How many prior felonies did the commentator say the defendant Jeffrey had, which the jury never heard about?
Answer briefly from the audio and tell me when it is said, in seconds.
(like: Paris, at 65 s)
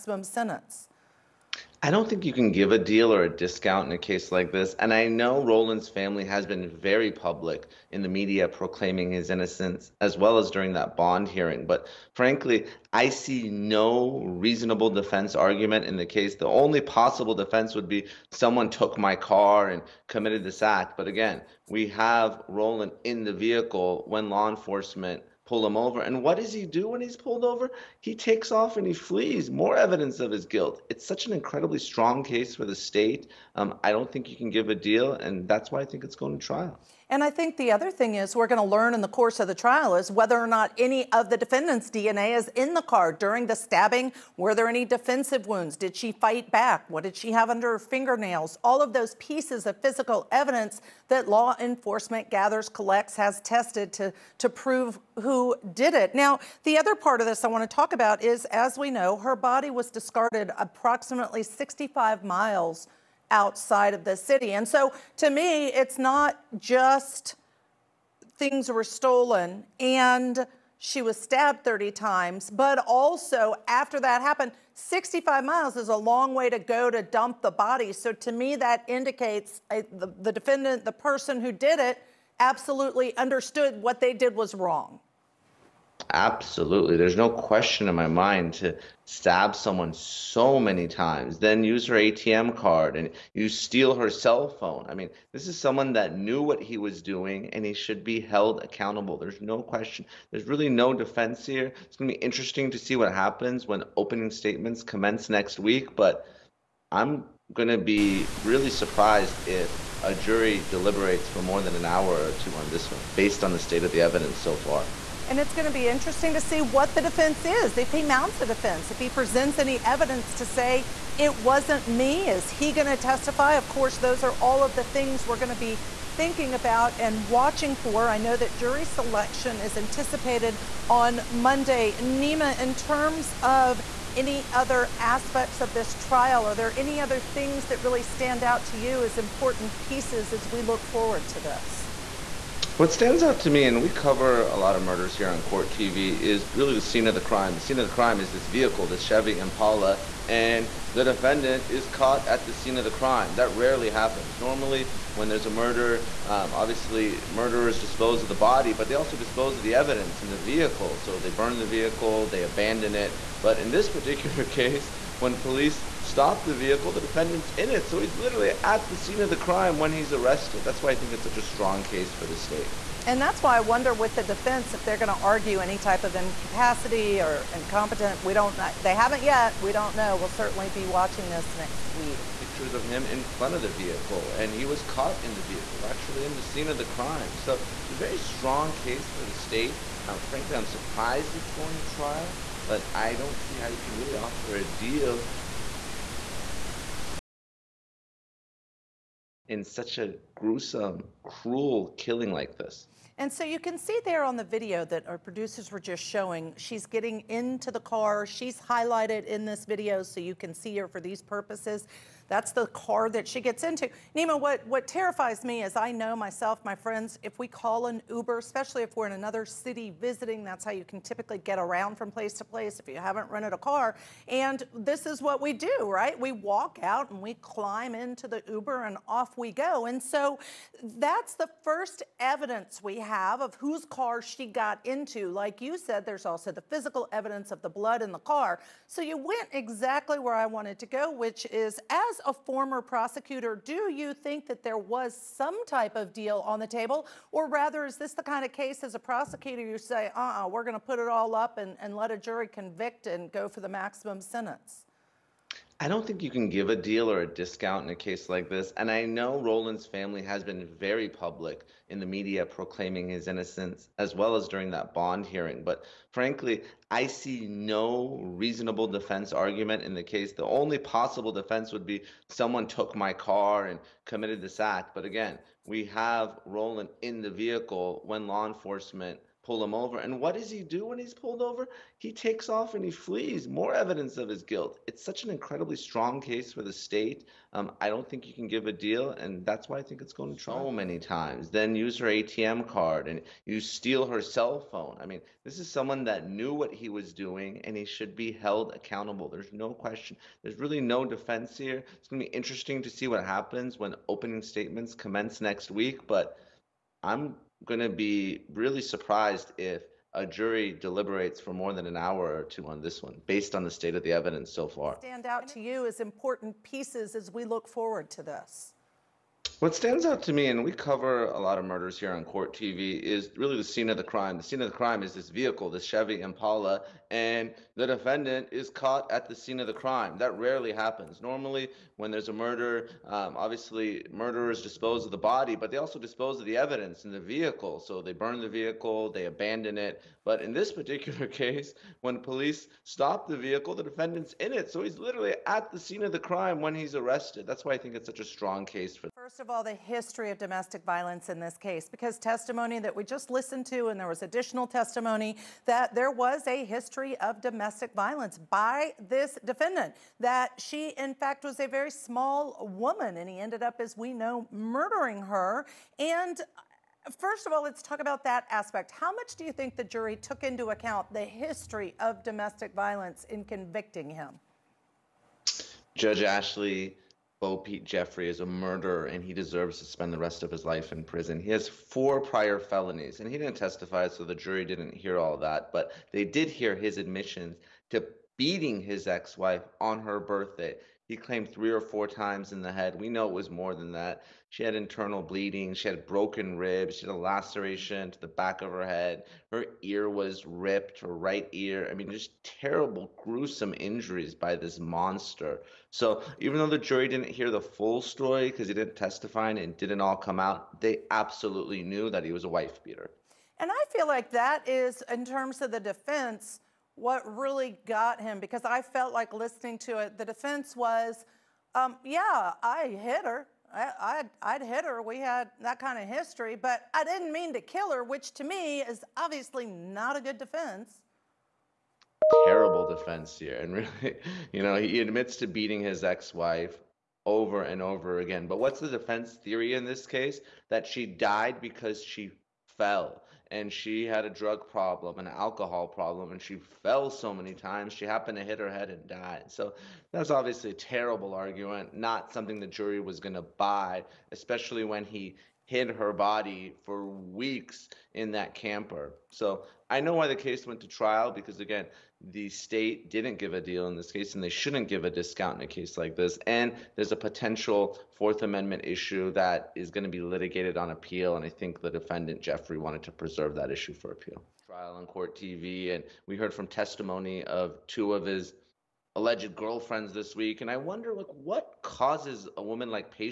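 4, at 381 s.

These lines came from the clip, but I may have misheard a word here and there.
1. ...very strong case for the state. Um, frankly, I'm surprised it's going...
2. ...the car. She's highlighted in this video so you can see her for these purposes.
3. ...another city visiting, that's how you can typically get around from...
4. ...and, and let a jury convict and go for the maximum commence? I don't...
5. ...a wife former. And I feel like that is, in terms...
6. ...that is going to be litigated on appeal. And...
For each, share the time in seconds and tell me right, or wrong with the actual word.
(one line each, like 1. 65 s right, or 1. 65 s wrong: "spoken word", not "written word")
1. 187 s right
2. 207 s right
3. 219 s right
4. 251 s wrong: "sentence", not "commence"
5. 412 s wrong: "beater", not "former"
6. 469 s right.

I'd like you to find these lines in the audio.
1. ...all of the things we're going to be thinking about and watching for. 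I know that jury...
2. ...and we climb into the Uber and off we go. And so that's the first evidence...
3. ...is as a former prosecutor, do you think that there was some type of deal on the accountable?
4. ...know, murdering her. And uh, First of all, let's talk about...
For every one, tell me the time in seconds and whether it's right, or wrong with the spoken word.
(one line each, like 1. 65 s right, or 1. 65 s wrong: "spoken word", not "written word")
1. 124 s right
2. 227 s right
3. 241 s wrong: "table", not "accountable"
4. 364 s right.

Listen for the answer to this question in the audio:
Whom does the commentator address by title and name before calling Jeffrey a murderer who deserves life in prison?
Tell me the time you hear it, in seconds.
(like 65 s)
375 s.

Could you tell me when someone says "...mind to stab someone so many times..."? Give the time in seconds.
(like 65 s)
88 s.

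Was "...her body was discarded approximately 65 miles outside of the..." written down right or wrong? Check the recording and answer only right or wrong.
right.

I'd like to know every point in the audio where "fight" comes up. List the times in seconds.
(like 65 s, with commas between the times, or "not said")
46 s.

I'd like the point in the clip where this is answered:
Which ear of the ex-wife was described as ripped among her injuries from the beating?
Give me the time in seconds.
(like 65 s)
400 s.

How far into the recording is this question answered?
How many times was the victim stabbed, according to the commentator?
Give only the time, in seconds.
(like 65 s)
71 s.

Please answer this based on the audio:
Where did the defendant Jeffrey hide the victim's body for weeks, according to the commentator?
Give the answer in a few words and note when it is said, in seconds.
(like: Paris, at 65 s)
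Camper, at 458 s.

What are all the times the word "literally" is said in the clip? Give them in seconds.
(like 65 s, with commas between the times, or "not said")
168 s, 344 s.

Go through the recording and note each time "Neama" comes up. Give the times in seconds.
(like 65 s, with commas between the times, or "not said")
131 s, 214 s.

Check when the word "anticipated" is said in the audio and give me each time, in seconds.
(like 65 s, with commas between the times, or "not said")
129 s.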